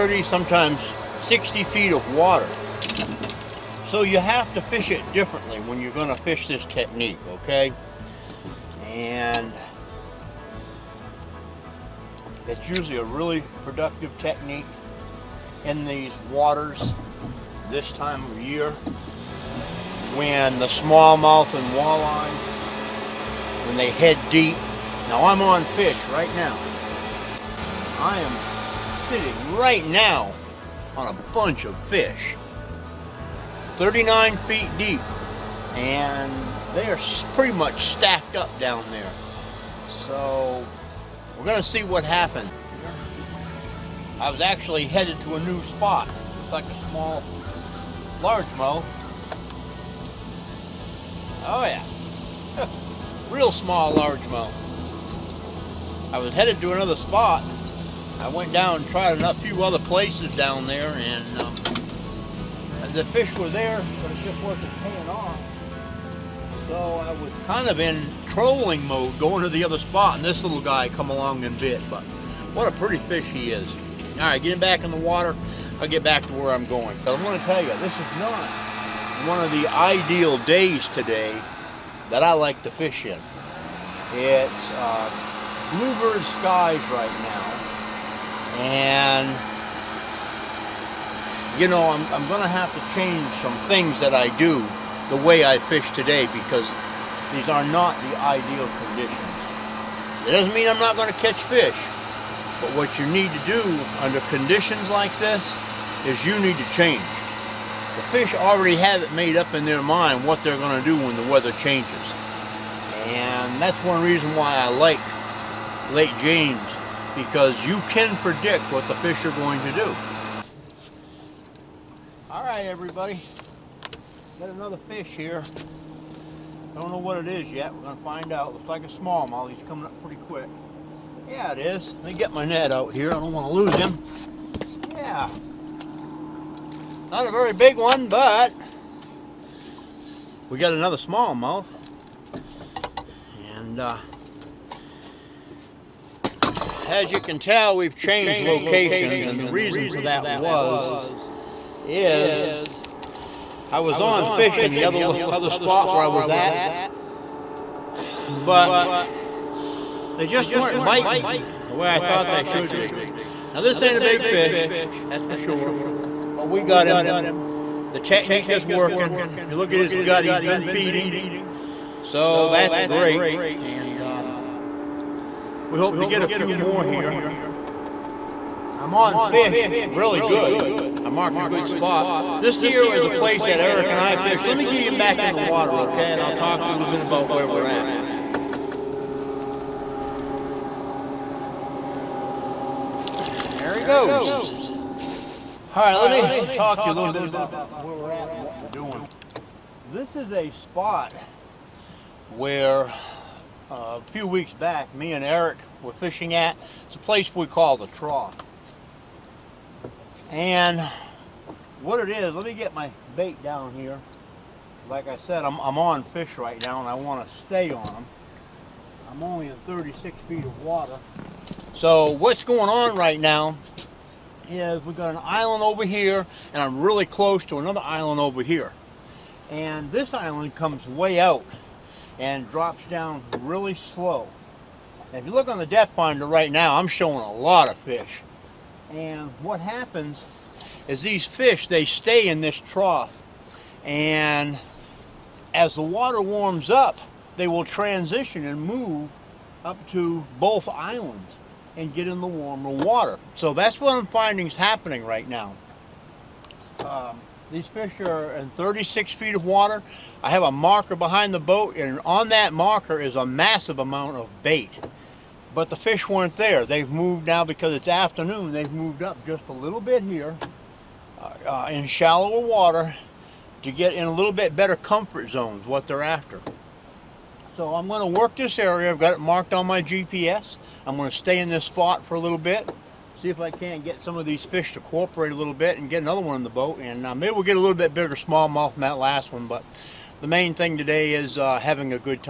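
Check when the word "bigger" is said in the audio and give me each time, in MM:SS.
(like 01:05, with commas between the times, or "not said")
04:47.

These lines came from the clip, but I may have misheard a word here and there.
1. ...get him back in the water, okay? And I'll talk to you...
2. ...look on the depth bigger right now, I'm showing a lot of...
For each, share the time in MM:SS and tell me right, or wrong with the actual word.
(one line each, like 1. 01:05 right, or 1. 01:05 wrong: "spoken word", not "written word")
1. 03:04 right
2. 03:55 wrong: "finder", not "bigger".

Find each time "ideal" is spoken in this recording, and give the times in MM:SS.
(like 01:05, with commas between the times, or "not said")
01:19, 01:38.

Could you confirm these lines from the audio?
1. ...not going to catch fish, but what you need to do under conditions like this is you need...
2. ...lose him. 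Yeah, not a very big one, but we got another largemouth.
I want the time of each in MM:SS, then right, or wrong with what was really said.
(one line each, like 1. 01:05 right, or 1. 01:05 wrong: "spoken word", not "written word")
1. 01:40 right
2. 02:13 wrong: "smallmouth", not "largemouth".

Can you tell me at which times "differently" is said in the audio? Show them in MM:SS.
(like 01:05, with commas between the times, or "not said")
00:05.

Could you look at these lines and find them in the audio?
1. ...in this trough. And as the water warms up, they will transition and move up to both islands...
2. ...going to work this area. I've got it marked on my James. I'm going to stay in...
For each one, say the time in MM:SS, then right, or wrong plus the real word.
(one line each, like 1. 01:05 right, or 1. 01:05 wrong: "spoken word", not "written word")
1. 04:02 right
2. 04:37 wrong: "GPS", not "James".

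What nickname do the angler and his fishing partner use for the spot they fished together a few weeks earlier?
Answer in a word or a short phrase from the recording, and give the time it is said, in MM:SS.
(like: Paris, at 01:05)
the trough, at 03:27.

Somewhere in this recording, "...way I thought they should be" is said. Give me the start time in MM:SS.
02:41.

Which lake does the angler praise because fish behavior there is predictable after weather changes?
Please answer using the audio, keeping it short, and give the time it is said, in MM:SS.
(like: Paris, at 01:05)
Lake James, at 01:55.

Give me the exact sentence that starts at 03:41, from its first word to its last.
So what's going on right now is we've got an island over here, and I'm really close to another island over here.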